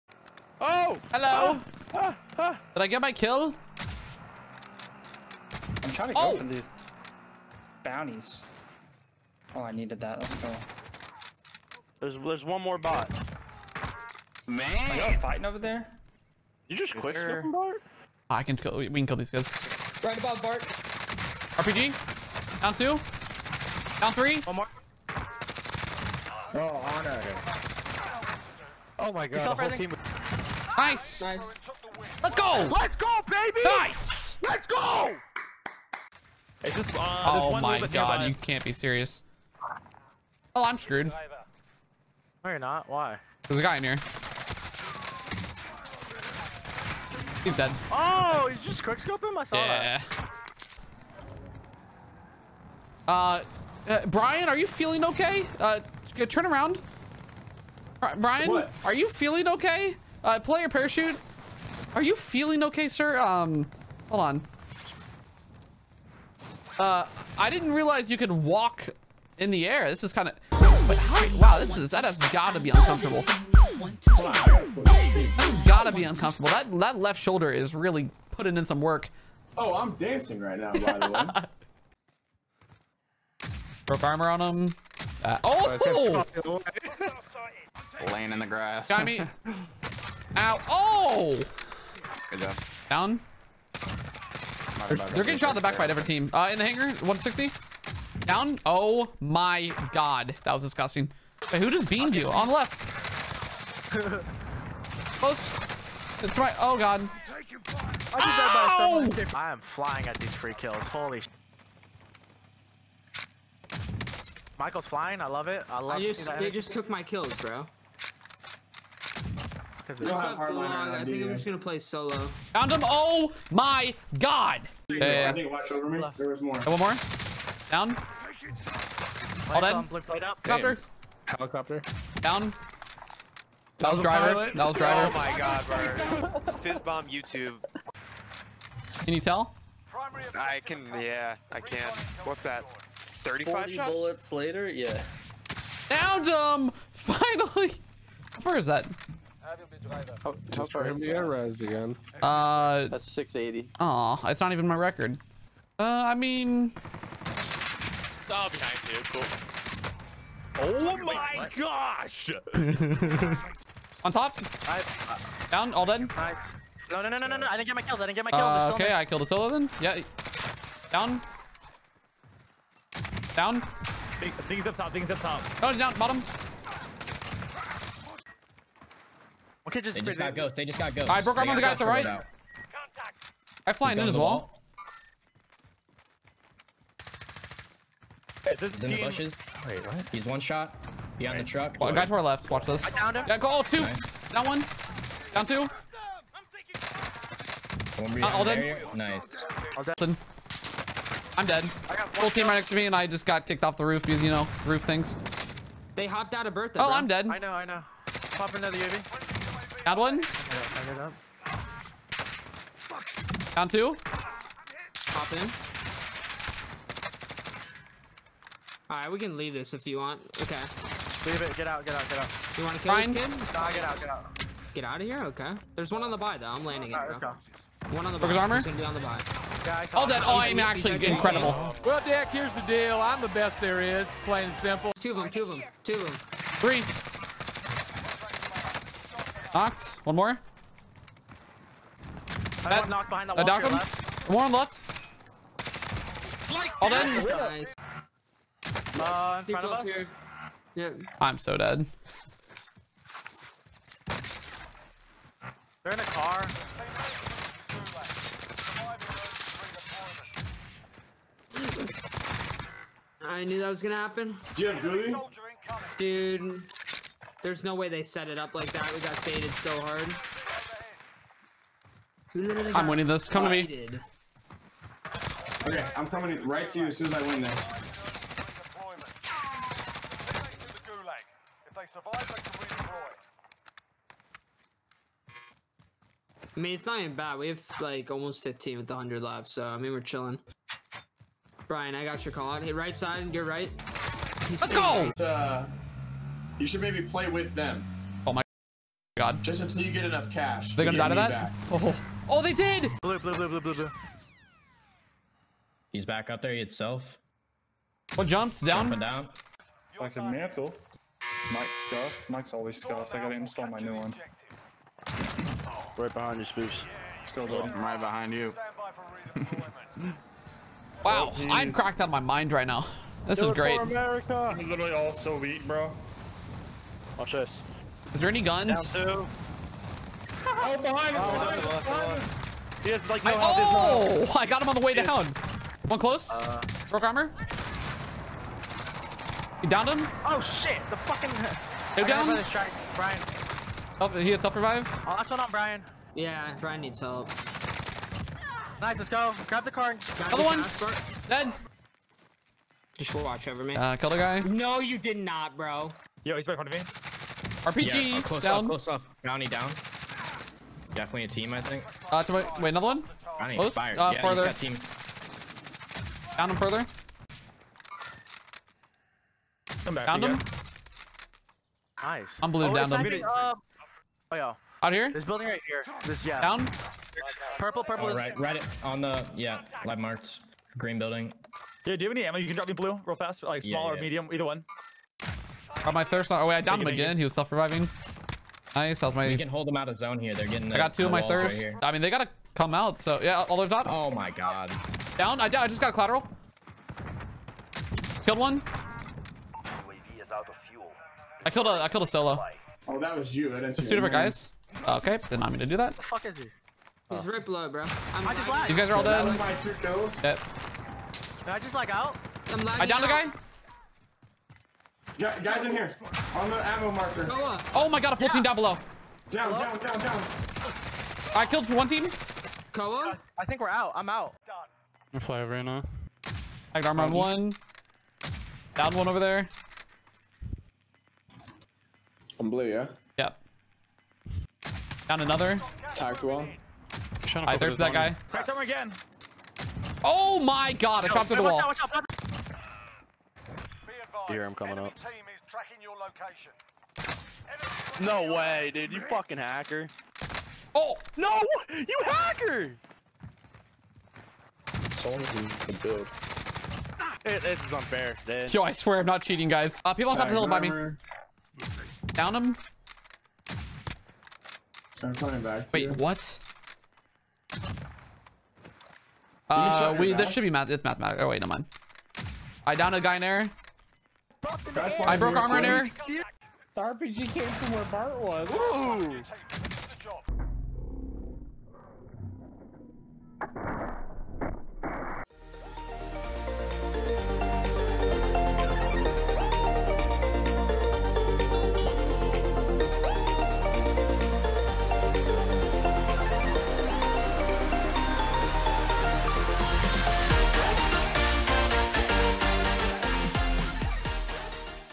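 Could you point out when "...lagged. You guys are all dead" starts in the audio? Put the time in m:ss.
6:48.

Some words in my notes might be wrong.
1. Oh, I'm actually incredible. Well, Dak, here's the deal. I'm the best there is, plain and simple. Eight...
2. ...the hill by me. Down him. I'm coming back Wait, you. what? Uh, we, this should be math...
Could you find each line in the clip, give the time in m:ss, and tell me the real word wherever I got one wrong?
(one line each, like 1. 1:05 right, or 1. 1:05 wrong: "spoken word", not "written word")
1. 3:50 wrong: "Two", not "Eight"
2. 7:40 right.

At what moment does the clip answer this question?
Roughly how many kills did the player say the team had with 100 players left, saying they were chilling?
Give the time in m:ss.
4:48.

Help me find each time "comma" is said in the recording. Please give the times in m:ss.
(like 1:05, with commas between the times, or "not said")
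not said.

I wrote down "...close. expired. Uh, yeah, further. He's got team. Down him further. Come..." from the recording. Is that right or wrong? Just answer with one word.
right.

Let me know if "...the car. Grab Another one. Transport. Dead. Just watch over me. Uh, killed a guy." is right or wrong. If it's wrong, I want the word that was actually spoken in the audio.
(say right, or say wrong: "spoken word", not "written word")
right.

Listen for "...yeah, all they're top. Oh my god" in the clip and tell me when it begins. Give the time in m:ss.
6:33.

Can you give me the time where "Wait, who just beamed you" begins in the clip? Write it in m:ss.
1:41.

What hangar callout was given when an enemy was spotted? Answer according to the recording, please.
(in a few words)
160.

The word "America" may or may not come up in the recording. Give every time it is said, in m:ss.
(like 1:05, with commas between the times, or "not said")
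5:23.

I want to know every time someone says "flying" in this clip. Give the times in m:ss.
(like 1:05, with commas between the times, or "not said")
1:49, 1:54, 3:03.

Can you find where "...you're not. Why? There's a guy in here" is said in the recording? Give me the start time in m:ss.
0:42.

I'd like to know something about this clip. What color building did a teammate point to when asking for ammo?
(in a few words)
Green.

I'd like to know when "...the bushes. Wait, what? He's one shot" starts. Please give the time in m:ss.
3:08.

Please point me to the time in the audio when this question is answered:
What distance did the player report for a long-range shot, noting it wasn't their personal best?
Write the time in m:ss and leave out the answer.
2:32.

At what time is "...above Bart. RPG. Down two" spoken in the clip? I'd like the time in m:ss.
0:20.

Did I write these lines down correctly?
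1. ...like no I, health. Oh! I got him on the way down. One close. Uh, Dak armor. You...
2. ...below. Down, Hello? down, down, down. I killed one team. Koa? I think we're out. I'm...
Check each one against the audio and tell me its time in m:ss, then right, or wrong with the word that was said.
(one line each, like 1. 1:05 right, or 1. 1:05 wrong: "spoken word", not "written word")
1. 5:33 wrong: "Broke", not "Dak"
2. 6:58 right.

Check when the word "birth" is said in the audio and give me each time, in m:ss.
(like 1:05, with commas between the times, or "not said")
3:26.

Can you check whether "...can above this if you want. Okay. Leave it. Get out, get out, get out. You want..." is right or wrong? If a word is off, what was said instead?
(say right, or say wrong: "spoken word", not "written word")
wrong: "leave", not "above".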